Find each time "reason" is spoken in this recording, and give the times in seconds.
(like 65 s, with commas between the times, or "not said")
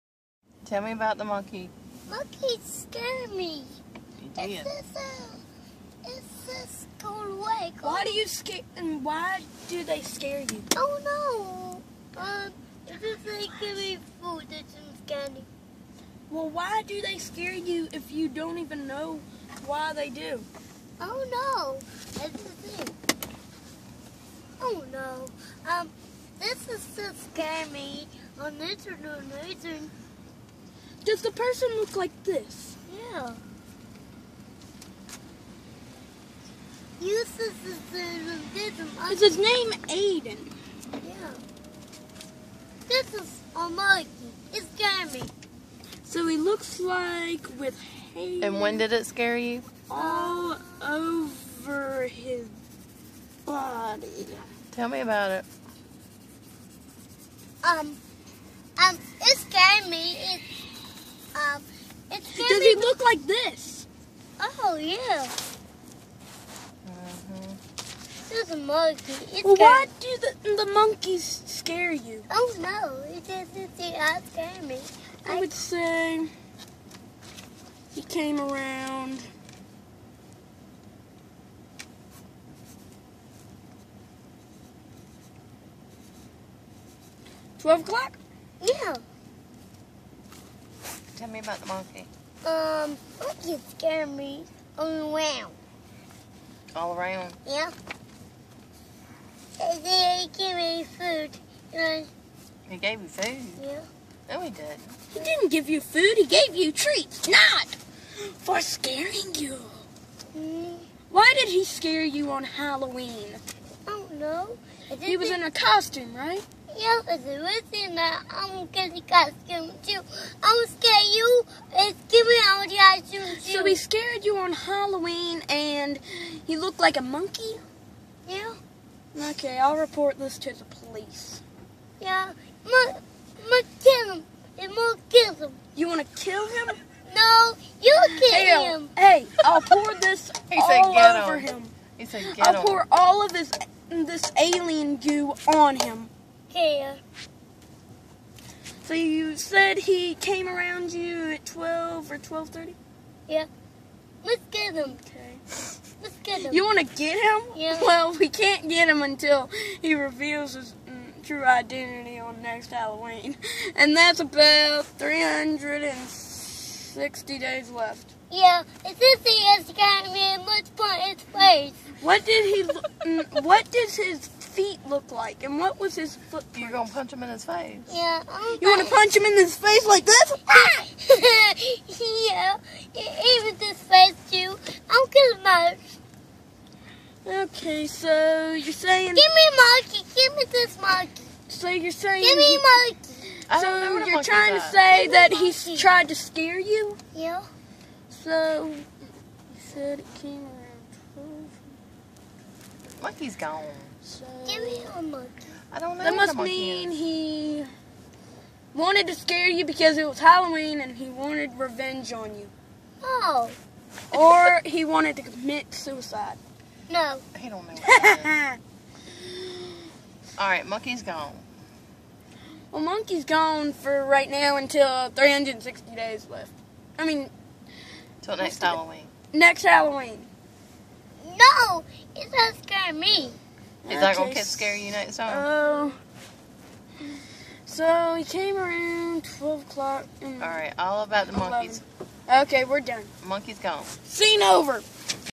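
29 s, 117 s.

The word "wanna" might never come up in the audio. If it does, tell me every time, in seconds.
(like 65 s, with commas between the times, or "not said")
178 s.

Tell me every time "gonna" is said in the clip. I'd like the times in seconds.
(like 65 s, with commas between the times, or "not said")
176 s, 185 s, 234 s.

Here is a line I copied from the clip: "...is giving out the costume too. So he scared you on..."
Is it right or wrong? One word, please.
right.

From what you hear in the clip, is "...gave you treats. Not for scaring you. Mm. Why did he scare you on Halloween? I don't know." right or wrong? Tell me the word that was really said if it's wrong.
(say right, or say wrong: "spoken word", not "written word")
right.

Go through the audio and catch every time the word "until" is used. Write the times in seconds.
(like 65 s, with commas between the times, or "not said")
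159 s, 224 s.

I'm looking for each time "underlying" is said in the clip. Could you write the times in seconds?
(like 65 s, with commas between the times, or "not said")
not said.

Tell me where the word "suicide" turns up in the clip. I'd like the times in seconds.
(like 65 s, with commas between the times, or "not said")
215 s.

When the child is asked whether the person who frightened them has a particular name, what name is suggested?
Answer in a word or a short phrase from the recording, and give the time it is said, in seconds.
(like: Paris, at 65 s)
Ayden, at 39 s.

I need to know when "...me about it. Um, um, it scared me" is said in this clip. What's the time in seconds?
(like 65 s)
54 s.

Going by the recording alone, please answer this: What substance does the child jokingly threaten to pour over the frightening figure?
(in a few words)
alien goo.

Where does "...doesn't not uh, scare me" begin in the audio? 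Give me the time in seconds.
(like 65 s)
73 s.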